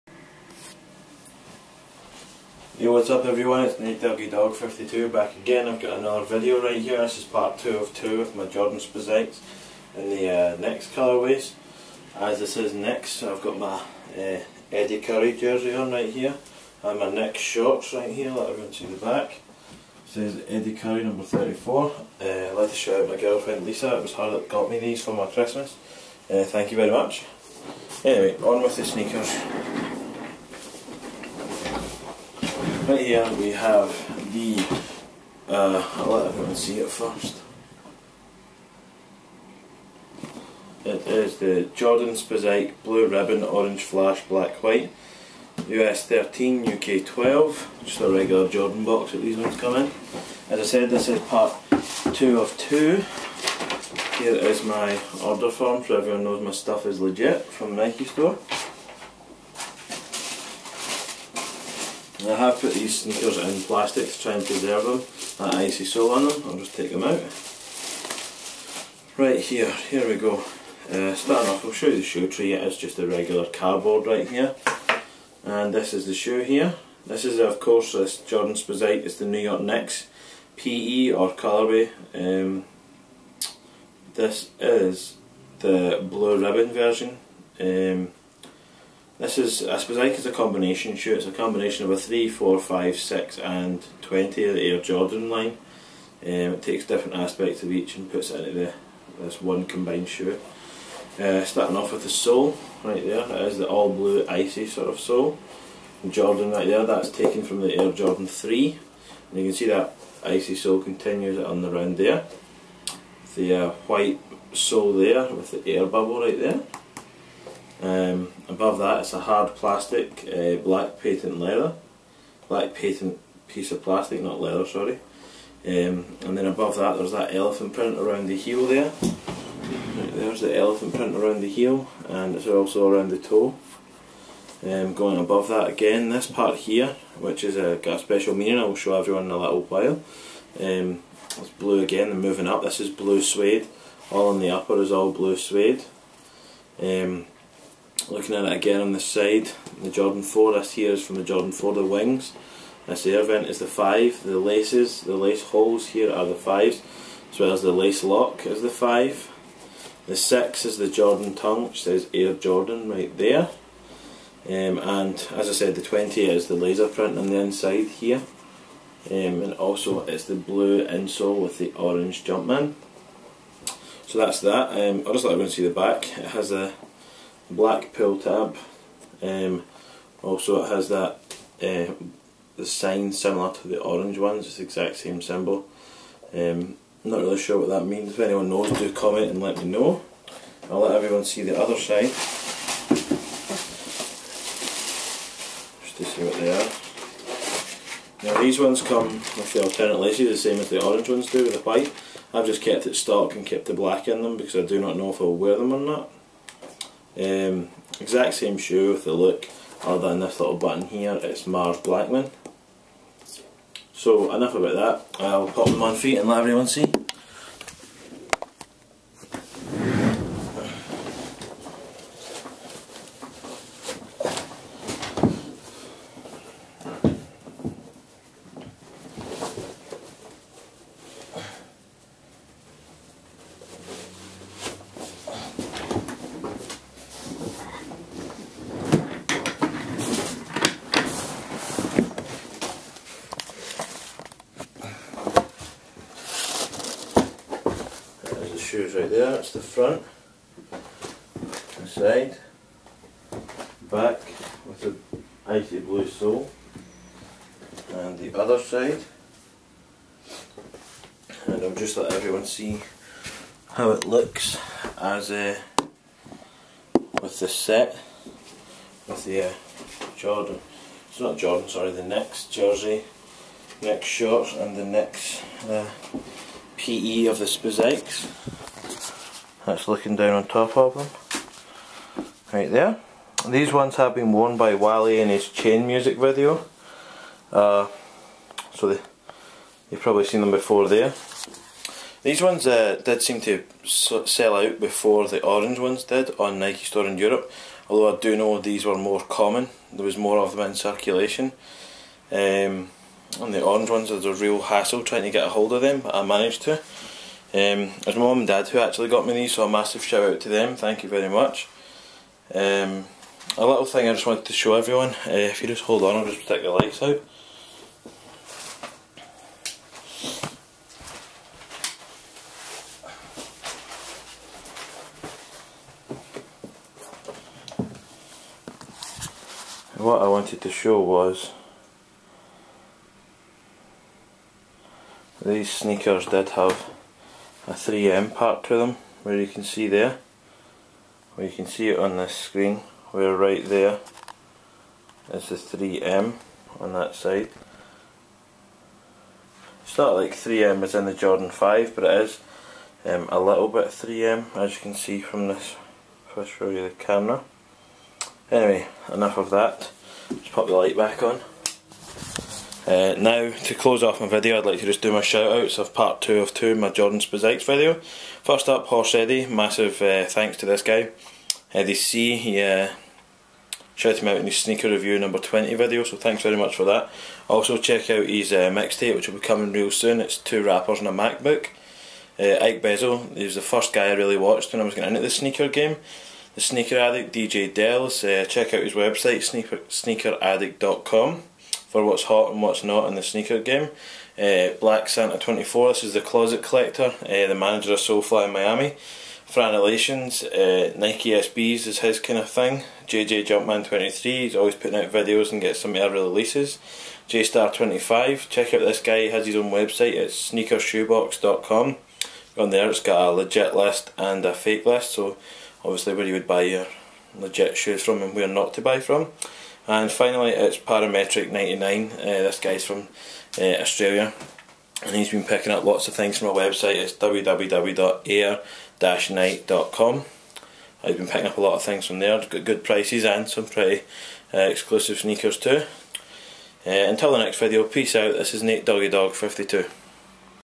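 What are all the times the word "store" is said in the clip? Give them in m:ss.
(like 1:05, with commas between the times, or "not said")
0:58, 4:56.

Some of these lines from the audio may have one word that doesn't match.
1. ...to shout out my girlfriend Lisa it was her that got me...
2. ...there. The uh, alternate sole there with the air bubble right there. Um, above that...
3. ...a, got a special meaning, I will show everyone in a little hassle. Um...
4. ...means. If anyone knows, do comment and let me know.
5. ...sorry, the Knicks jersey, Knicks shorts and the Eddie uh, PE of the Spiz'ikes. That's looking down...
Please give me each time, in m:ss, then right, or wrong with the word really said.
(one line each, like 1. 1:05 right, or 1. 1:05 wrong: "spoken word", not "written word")
1. 0:22 right
2. 1:51 wrong: "white", not "alternate"
3. 2:17 wrong: "while", not "hassle"
4. 3:07 right
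5. 4:31 wrong: "Knicks", not "Eddie".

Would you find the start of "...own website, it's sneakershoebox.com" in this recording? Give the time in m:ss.
6:49.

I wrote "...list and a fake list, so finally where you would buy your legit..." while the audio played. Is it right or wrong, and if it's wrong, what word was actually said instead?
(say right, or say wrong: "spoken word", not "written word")
wrong: "obviously", not "finally".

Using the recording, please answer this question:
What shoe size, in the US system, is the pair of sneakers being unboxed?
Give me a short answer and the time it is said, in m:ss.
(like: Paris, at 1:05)
13, at 0:45.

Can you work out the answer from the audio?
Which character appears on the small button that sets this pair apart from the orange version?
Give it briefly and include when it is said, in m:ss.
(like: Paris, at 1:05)
Mars Blackman, at 3:31.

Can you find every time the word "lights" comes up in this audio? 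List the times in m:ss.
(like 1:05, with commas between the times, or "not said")
5:16, 6:00.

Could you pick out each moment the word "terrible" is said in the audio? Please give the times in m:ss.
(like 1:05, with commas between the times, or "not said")
not said.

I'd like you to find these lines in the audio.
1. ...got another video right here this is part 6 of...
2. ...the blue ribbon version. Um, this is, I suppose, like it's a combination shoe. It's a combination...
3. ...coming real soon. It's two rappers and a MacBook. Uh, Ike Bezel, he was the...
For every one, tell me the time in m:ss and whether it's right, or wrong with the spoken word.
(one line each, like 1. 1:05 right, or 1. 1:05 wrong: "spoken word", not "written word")
1. 0:05 wrong: "2", not "6"
2. 1:25 right
3. 6:19 right.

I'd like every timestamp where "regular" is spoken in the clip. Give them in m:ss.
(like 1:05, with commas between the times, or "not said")
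0:48, 1:13.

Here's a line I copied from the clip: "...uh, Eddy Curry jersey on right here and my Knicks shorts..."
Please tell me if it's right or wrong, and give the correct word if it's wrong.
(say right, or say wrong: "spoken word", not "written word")
right.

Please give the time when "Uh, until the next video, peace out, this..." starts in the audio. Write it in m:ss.
7:16.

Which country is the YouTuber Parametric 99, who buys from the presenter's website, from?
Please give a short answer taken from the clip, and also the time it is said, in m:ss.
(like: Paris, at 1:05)
Australia, at 7:03.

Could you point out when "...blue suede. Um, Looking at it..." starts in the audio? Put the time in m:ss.
2:25.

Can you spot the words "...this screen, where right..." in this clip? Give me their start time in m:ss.
5:42.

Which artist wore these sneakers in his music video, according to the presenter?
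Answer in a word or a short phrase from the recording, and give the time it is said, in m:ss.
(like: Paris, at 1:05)
Wale, at 4:44.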